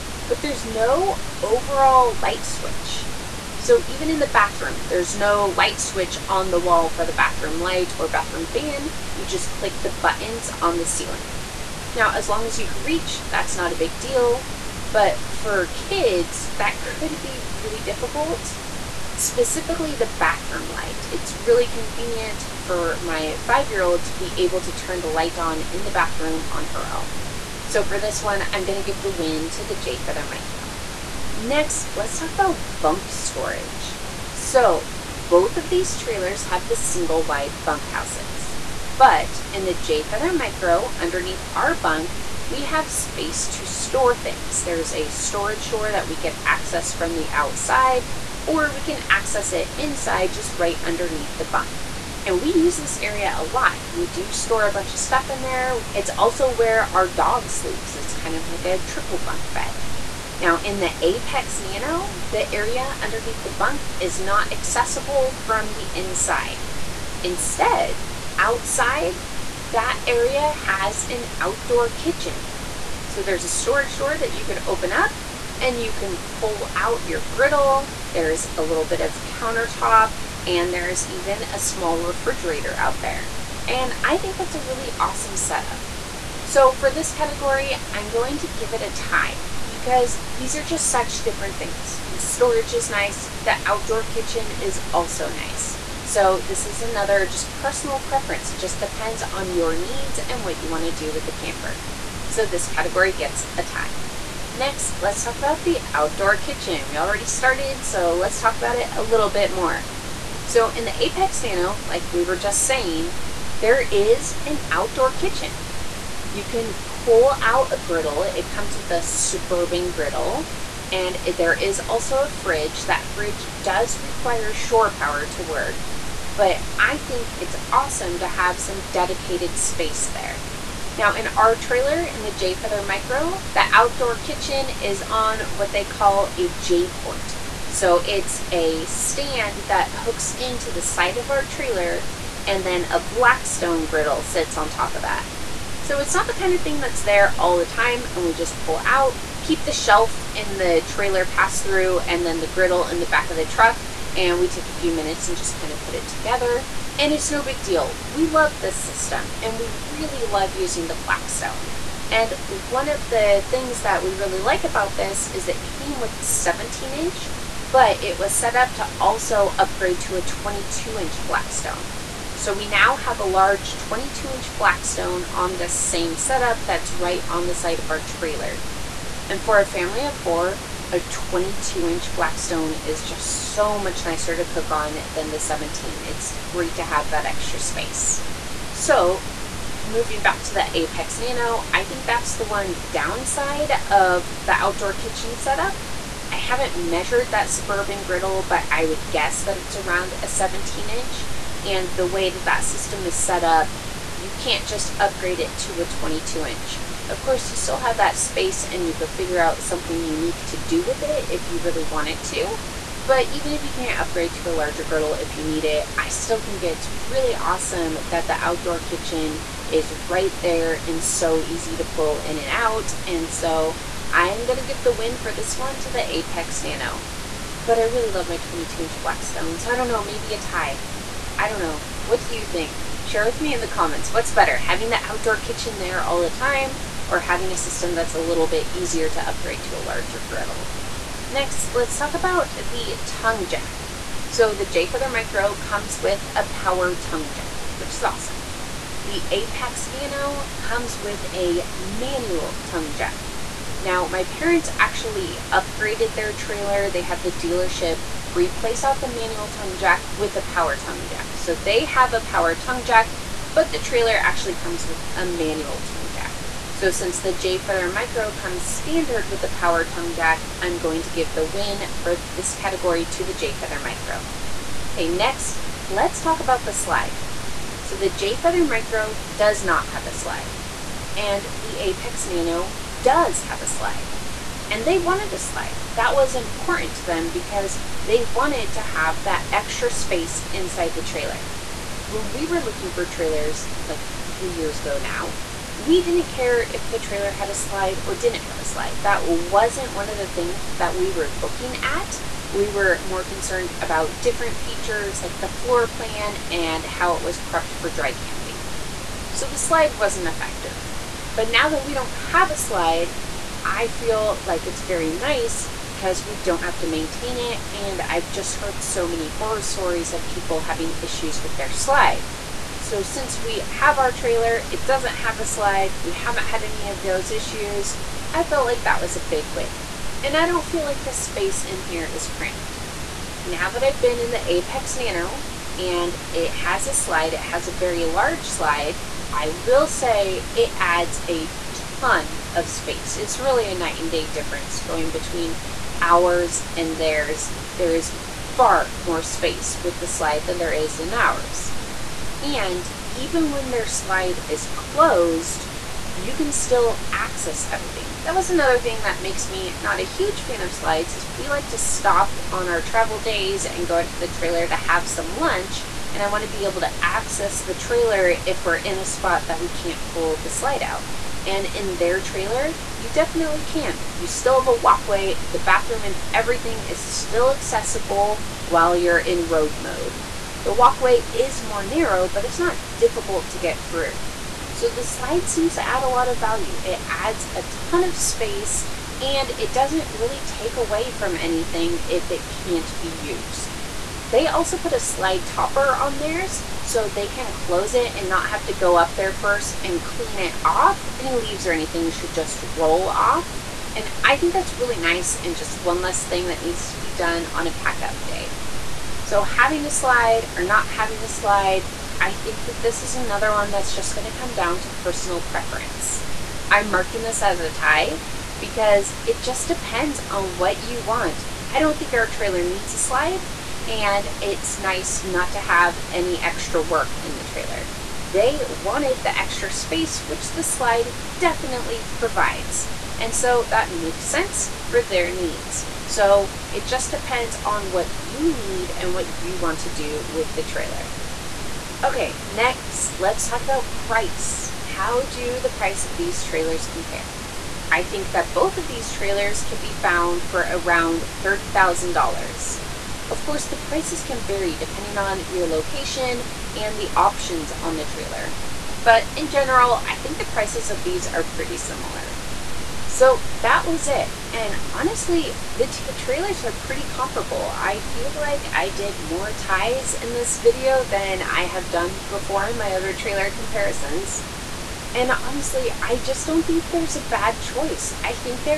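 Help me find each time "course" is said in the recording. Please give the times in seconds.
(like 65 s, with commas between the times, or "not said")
207 s, 453 s.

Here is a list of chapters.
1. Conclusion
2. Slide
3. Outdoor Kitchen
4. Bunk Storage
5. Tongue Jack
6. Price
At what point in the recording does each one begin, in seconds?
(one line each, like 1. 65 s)
1. 464 s
2. 277 s
3. 105 s
4. 32 s
5. 242 s
6. 444 s.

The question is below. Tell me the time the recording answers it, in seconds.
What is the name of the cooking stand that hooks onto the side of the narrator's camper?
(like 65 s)
136 s.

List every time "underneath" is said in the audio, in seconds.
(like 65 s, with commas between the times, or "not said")
40 s, 50 s, 63 s.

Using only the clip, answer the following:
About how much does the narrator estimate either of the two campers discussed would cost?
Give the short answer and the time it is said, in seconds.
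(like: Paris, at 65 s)
$30,000, at 451 s.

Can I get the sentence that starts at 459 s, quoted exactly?
But in general, I think the prices of these are pretty similar.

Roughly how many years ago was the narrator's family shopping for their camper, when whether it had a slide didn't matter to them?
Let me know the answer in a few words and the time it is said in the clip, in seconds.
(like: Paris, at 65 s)
3, at 294 s.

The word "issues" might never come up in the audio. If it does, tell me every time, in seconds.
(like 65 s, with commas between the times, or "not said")
321 s, 327 s.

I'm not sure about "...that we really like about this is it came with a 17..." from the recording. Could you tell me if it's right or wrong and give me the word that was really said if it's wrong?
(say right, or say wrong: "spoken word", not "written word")
right.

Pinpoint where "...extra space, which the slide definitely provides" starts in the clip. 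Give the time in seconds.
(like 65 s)
429 s.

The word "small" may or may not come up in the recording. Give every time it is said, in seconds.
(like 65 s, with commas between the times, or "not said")
81 s.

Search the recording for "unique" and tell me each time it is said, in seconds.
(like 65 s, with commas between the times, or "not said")
209 s.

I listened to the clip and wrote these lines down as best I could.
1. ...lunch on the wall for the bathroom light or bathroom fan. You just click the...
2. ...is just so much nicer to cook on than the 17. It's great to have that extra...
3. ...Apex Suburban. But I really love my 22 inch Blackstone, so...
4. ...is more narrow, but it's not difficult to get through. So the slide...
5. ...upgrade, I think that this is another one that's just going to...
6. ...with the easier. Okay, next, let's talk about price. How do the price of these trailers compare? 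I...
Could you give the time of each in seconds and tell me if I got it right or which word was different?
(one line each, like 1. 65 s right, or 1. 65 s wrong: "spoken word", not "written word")
1. 5 s wrong: "switch", not "lunch"
2. 182 s right
3. 226 s wrong: "Nano", not "Suburban"
4. 381 s right
5. 411 s wrong: "slide", not "upgrade"
6. 440 s wrong: "trailer", not "easier".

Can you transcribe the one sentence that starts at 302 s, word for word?
We were more concerned about different features like the floor plan and how it was prepped for dry camping.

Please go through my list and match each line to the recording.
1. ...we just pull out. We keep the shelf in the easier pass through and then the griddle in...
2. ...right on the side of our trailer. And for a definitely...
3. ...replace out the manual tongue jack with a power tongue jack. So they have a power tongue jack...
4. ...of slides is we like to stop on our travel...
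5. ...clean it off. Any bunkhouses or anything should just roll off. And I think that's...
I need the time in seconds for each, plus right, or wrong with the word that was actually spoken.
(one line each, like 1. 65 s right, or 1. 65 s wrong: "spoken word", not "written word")
1. 148 s wrong: "trailer", not "easier"
2. 176 s wrong: "family", not "definitely"
3. 258 s right
4. 360 s right
5. 400 s wrong: "leaves", not "bunkhouses".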